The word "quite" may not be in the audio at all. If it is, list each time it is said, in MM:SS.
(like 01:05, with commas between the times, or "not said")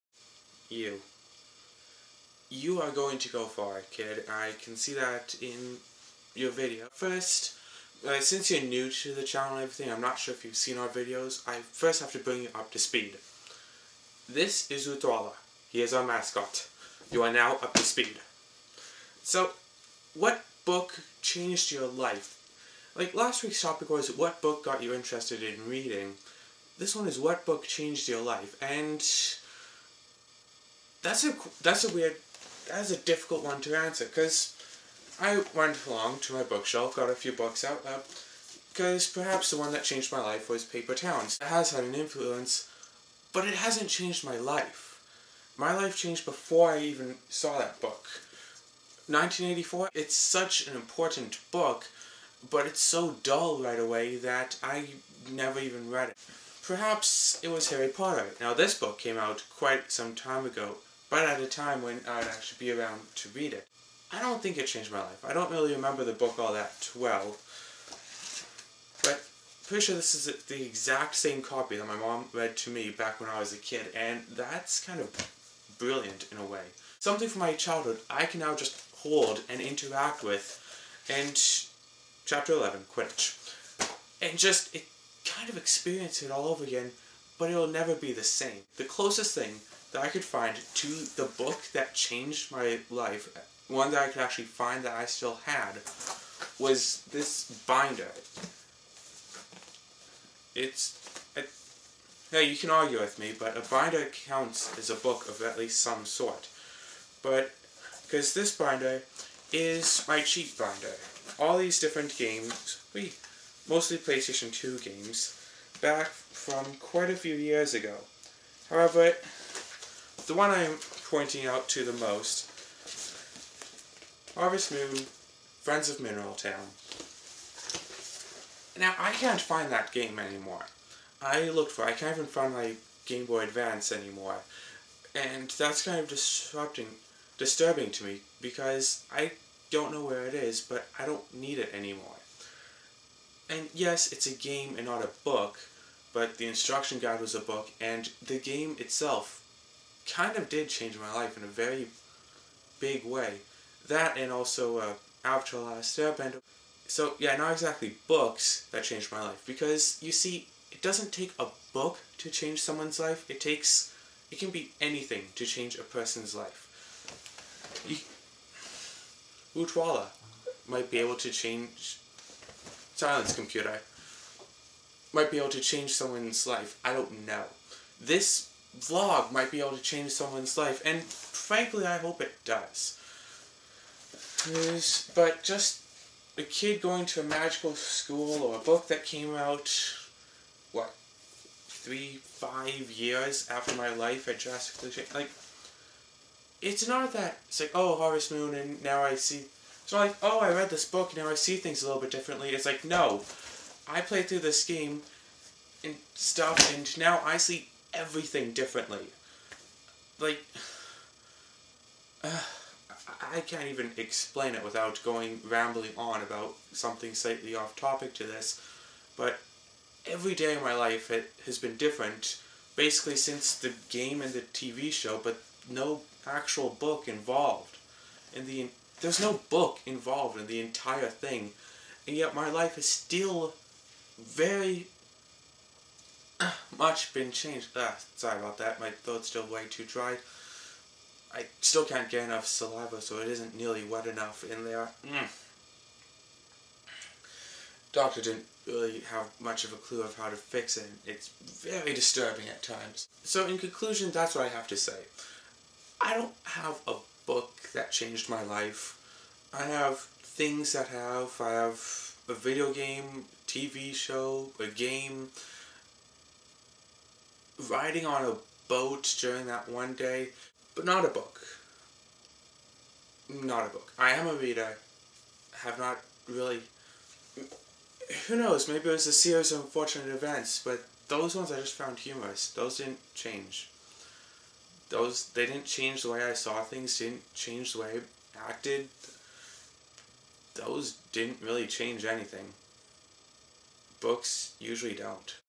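00:59, 01:56.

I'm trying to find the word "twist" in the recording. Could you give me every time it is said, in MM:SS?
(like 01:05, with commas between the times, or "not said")
not said.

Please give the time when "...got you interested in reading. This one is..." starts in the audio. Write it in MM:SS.
00:24.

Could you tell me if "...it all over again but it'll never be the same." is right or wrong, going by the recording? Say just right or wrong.
right.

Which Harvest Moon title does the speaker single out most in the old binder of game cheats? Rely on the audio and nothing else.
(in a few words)
Friends of Mineral Town.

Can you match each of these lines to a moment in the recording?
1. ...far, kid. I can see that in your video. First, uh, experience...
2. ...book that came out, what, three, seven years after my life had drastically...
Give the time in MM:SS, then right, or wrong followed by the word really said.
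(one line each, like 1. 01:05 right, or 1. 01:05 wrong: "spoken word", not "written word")
1. 00:03 wrong: "since", not "experience"
2. 03:08 wrong: "five", not "seven".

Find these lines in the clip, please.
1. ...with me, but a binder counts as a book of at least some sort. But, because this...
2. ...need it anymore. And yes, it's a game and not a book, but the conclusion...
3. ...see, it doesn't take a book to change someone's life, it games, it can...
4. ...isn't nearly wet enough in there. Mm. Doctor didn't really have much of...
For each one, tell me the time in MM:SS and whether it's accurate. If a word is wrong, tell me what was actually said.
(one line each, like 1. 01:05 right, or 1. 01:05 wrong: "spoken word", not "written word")
1. 01:42 right
2. 02:21 wrong: "instruction", not "conclusion"
3. 02:40 wrong: "takes", not "games"
4. 04:03 right.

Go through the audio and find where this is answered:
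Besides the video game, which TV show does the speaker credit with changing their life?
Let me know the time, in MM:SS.
02:35.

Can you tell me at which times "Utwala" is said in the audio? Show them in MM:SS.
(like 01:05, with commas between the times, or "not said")
00:14, 02:49.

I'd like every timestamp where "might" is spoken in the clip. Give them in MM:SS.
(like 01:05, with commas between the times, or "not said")
02:50, 02:55, 02:59.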